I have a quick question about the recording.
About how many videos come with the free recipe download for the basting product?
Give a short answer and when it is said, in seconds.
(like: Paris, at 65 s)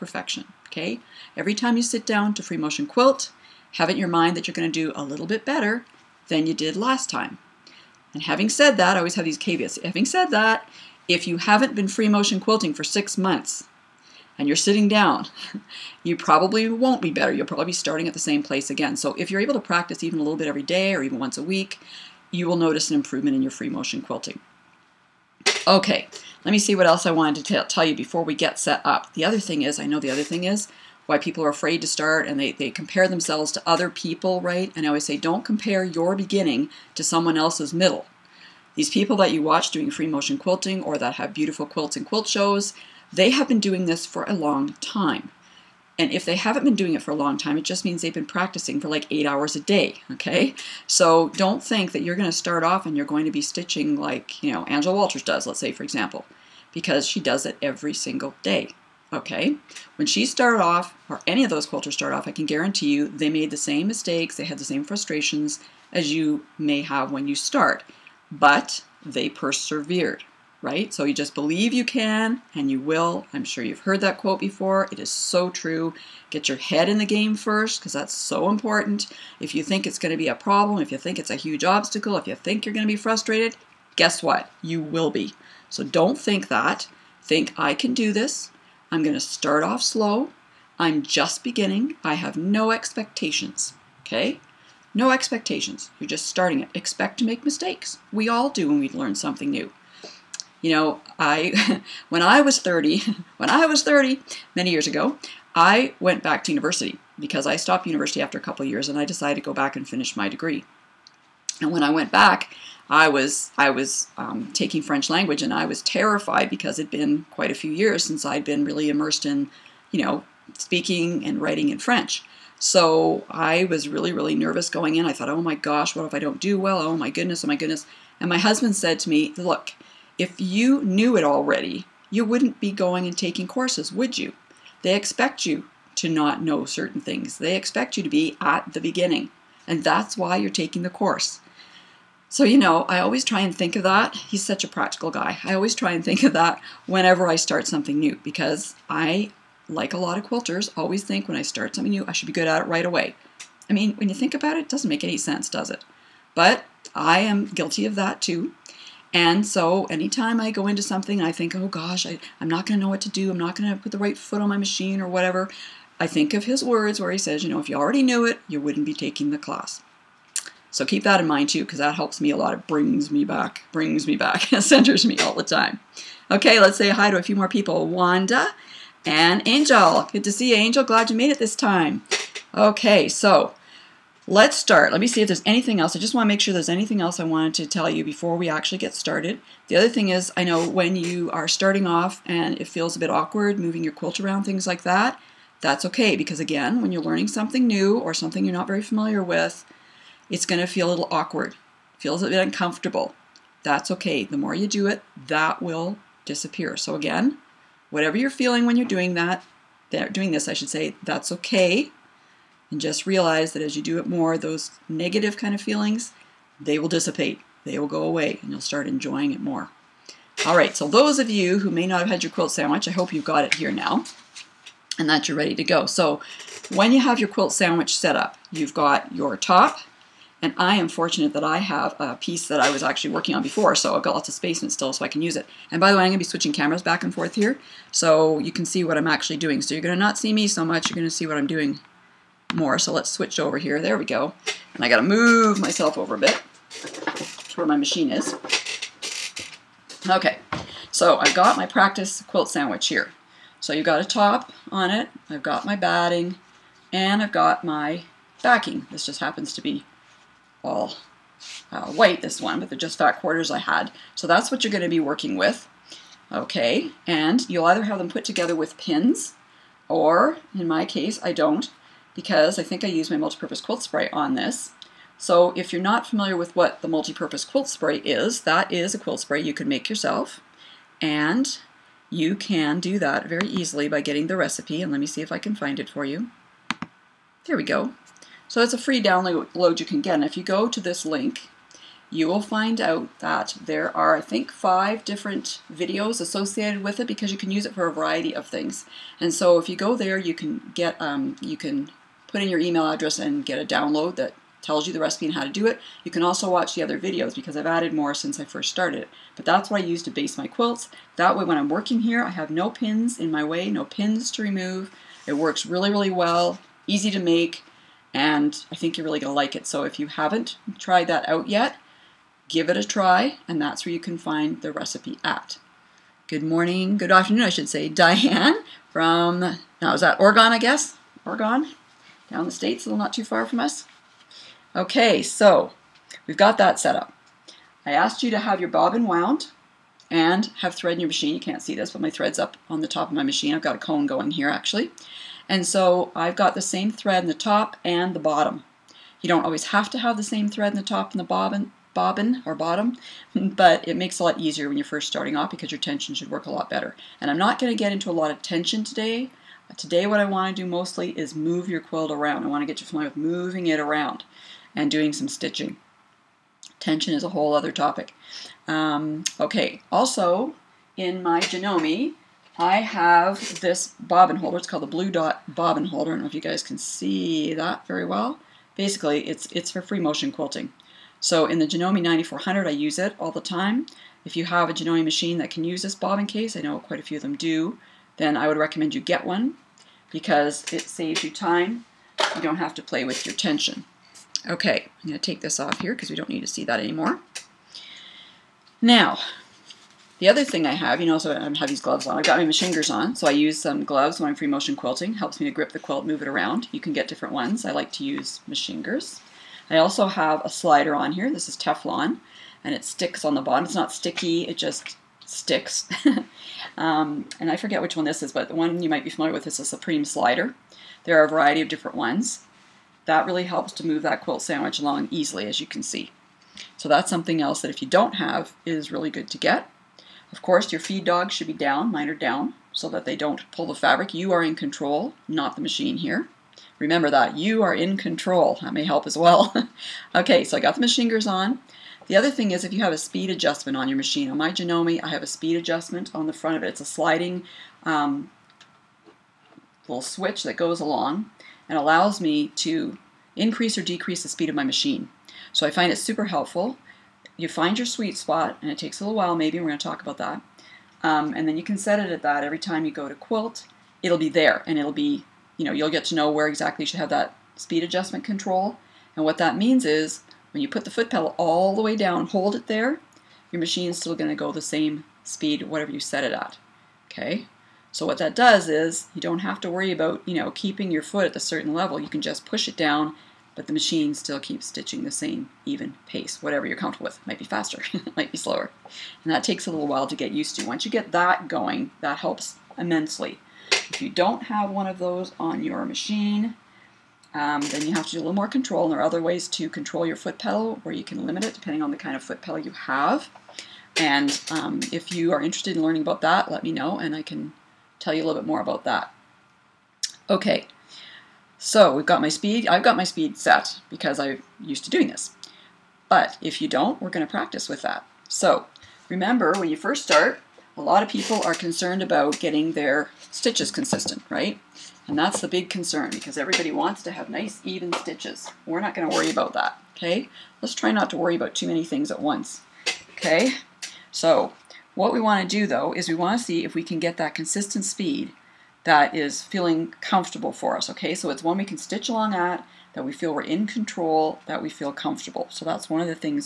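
5, at 294 s.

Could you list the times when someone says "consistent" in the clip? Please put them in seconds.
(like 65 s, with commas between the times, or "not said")
523 s, 537 s.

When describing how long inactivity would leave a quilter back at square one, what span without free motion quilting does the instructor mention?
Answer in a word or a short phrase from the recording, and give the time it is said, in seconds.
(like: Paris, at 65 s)
6 months, at 12 s.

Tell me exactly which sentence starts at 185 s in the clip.
I just want to make sure there's anything else I wanted to tell you before we actually get started.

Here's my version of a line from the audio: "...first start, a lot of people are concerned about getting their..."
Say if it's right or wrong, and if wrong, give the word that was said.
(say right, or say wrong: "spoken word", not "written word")
right.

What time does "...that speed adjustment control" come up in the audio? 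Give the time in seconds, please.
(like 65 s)
467 s.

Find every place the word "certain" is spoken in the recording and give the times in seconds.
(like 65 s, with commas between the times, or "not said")
136 s, 481 s.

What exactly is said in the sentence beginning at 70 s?
So you just believe you can and you will.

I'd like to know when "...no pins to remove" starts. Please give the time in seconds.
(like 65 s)
313 s.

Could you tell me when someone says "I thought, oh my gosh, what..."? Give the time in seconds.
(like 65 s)
125 s.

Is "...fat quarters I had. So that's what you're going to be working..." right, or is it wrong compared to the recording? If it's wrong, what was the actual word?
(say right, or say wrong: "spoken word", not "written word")
right.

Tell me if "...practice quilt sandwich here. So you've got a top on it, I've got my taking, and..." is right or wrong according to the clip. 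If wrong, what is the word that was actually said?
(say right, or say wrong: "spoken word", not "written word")
wrong: "batting", not "taking".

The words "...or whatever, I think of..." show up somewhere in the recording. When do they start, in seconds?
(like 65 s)
164 s.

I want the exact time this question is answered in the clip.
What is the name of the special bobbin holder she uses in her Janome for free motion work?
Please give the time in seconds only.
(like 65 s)
374 s.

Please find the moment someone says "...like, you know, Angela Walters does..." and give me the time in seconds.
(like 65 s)
53 s.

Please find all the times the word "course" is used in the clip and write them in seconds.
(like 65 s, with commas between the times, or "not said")
133 s, 140 s, 430 s.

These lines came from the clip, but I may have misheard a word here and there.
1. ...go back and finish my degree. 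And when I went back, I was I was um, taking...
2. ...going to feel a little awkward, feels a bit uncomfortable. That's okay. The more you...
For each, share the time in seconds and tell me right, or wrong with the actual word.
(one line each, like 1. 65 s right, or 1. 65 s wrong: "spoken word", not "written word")
1. 109 s right
2. 200 s right.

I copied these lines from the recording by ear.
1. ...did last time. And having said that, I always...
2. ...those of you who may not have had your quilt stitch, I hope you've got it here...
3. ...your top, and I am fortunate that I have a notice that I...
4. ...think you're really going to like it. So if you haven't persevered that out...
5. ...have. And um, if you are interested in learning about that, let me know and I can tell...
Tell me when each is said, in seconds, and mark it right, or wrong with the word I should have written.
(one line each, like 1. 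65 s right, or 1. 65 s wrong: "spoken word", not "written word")
1. 6 s right
2. 220 s wrong: "sandwich", not "stitch"
3. 229 s wrong: "piece", not "notice"
4. 318 s wrong: "tried", not "persevered"
5. 502 s right.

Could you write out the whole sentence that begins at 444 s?
On my Janome, I have a speed adjustment on the front of it.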